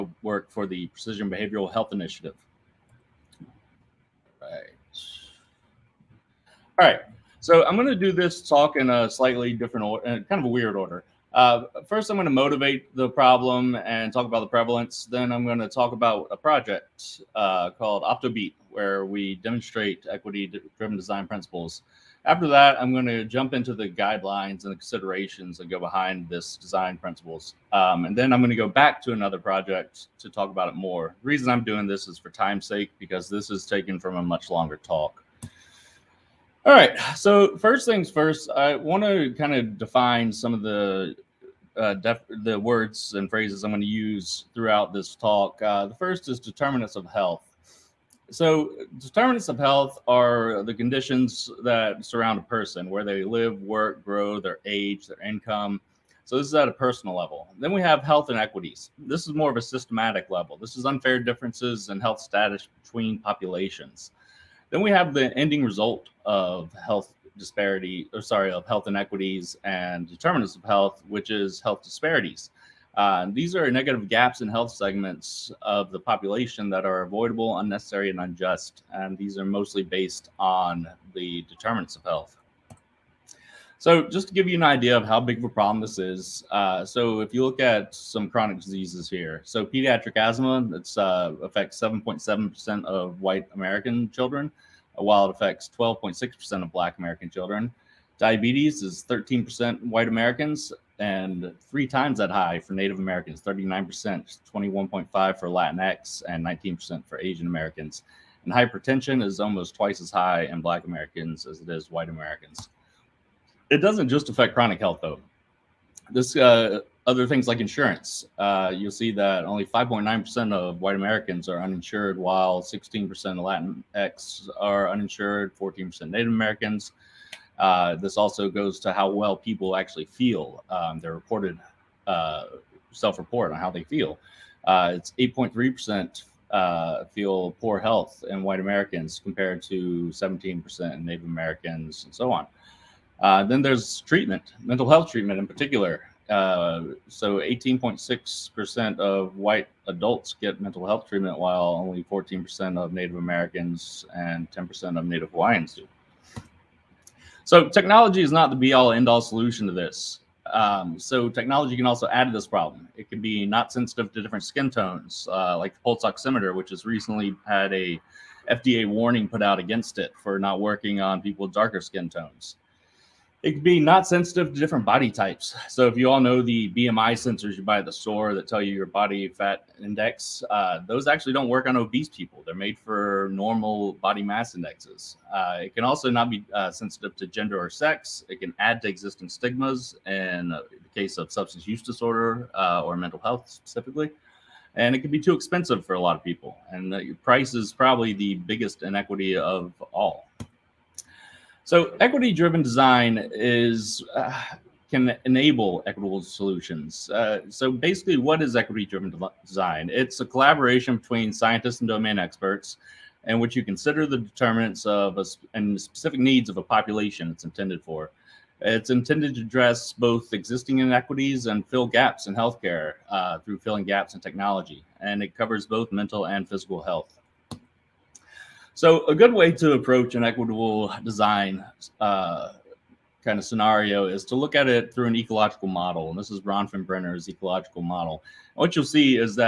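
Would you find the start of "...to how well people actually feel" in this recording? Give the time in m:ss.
2:08.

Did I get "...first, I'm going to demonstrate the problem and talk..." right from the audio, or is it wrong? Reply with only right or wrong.
wrong.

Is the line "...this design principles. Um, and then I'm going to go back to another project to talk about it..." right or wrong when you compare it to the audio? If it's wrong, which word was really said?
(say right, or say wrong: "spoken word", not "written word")
right.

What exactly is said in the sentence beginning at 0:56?
So this is at a personal level.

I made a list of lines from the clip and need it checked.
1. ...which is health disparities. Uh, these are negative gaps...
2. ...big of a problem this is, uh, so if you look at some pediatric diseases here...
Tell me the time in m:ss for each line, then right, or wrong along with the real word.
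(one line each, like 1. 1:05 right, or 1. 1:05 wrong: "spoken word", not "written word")
1. 1:11 right
2. 1:25 wrong: "chronic", not "pediatric".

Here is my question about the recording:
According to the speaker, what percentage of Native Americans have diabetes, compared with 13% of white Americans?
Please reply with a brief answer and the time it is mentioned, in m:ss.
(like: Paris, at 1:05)
39%, at 1:43.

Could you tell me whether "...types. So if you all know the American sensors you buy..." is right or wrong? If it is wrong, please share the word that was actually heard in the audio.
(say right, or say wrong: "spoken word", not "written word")
wrong: "BMI", not "American".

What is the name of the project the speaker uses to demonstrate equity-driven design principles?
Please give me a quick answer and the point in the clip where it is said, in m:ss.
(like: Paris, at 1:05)
OptoBeat, at 0:18.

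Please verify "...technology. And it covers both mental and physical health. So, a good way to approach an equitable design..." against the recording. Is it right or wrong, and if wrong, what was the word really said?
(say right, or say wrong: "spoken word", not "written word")
right.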